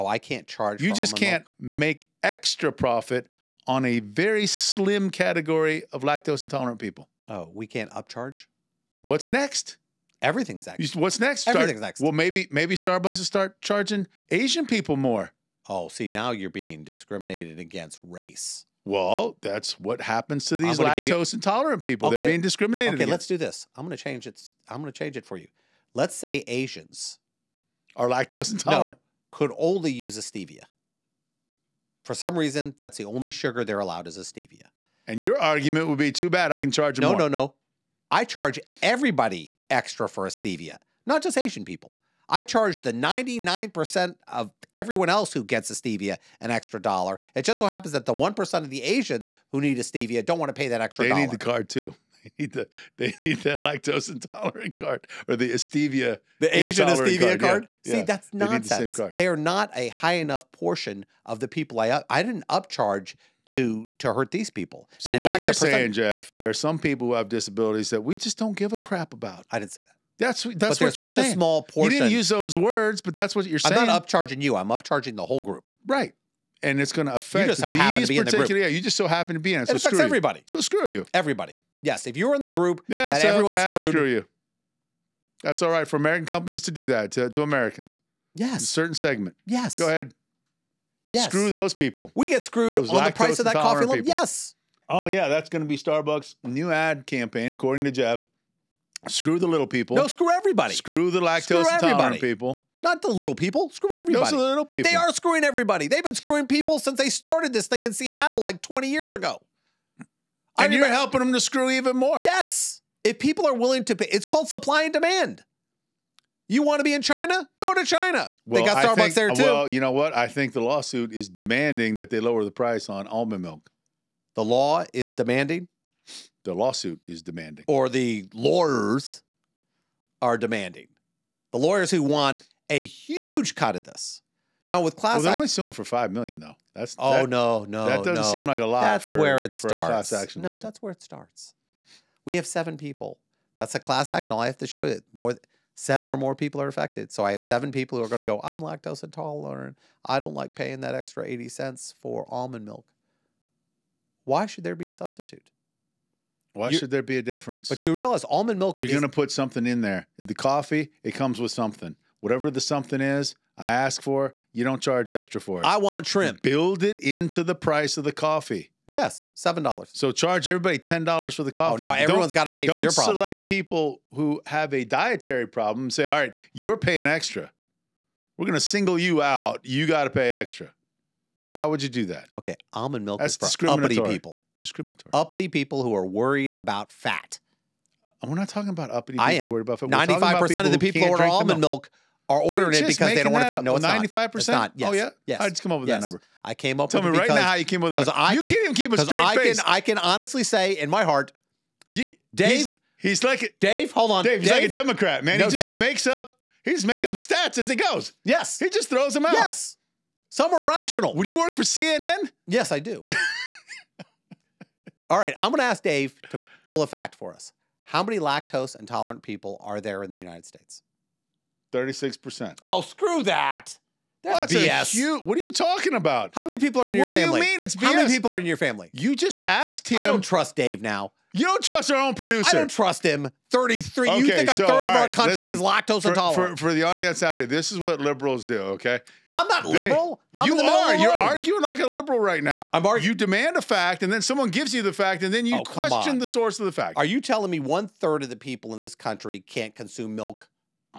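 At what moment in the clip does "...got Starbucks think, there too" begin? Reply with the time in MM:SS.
01:58.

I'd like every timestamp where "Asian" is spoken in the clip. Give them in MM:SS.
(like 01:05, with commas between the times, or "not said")
00:14, 00:26, 00:41, 00:48, 00:56.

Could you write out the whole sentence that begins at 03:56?
For, for, the audience out here, this is what liberals do, okay?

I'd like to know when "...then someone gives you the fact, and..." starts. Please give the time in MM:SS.
04:04.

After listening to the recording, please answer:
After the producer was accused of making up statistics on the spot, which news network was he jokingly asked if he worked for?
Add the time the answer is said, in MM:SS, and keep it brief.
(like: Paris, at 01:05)
CNN, at 03:31.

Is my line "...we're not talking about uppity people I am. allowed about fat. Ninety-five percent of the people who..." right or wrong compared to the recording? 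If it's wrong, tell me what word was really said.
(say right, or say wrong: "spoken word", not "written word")
wrong: "worried", not "allowed".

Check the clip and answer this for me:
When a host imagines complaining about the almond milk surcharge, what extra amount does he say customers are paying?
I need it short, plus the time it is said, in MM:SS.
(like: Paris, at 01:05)
80 cents, at 02:31.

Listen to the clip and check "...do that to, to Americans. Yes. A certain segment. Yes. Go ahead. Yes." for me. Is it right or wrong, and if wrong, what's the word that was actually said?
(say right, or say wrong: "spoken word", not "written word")
right.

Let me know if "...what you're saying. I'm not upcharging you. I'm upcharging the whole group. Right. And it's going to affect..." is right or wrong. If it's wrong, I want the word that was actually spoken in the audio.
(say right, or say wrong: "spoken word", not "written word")
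right.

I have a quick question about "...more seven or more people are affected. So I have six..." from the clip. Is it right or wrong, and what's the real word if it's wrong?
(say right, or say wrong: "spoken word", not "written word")
wrong: "seven", not "six".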